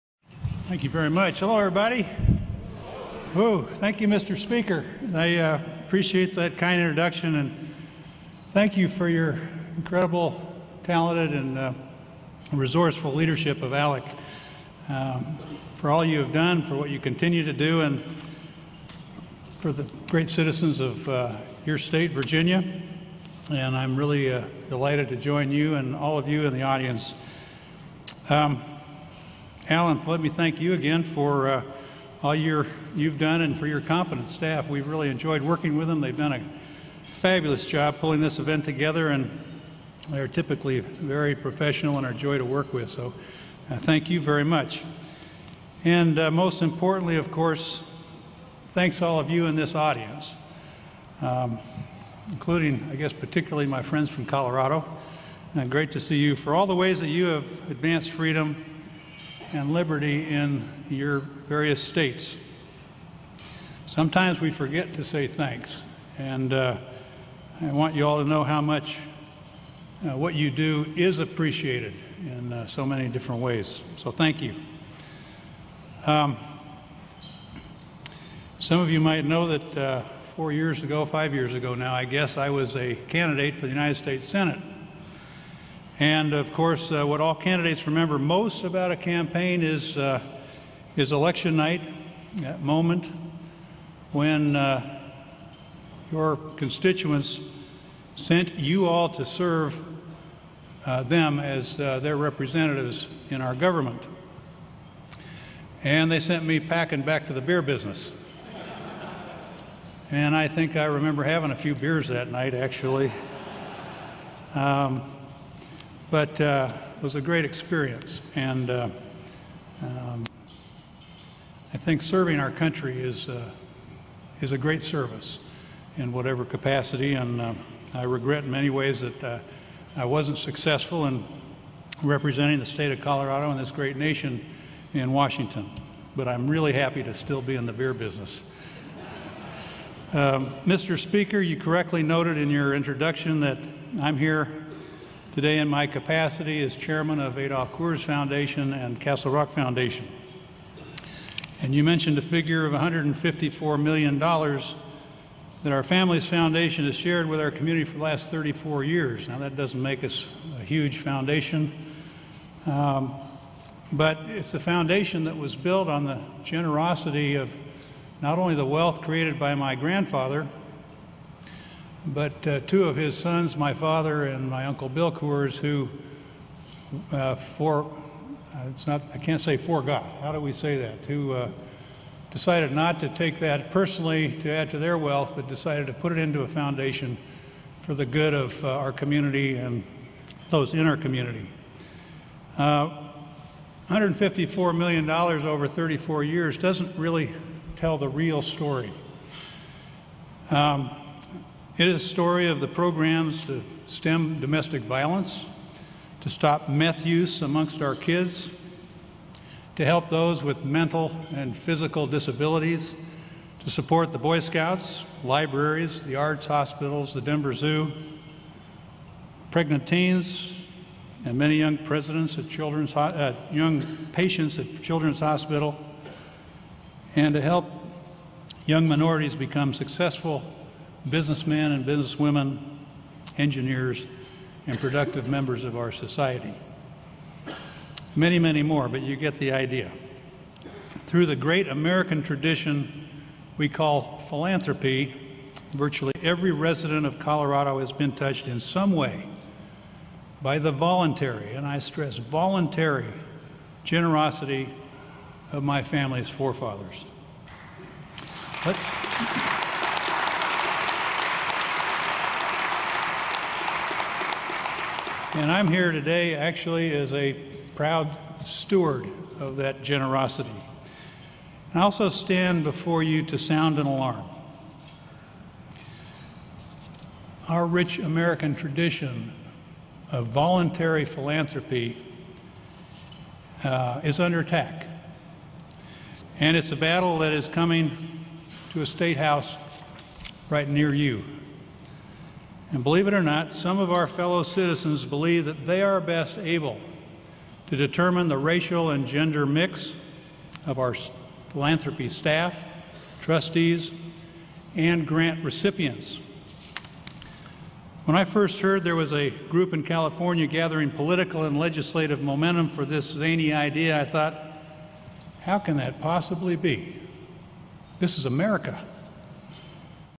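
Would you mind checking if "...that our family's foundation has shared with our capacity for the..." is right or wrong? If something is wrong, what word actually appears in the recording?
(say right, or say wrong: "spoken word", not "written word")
wrong: "community", not "capacity".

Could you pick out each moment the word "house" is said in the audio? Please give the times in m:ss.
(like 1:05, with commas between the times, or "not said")
4:49.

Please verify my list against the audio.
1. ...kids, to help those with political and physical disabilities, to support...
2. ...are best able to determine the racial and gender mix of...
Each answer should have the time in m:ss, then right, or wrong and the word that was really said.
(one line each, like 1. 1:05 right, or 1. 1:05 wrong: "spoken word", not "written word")
1. 3:27 wrong: "mental", not "political"
2. 4:55 right.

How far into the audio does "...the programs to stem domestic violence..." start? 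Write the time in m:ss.
3:22.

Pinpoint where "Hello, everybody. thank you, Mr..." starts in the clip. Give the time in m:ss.
0:01.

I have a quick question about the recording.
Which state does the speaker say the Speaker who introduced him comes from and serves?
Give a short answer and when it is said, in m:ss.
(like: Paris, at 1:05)
Virginia, at 0:22.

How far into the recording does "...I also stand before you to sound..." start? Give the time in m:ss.
4:31.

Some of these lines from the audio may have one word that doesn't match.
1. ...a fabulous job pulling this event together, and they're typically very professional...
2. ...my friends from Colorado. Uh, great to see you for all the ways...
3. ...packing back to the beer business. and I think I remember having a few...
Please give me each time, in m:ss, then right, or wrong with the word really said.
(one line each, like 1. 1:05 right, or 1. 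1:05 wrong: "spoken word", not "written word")
1. 0:36 right
2. 0:53 right
3. 1:46 right.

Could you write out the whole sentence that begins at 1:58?
And uh, um, I think serving our country is, uh, is a great service in whatever capacity.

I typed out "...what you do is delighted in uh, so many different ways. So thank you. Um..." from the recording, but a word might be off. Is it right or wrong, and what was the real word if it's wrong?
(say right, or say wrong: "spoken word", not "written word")
wrong: "appreciated", not "delighted".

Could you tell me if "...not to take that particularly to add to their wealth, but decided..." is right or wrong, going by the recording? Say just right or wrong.
wrong.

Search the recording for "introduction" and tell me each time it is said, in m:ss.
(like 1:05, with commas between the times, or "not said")
0:06, 2:22.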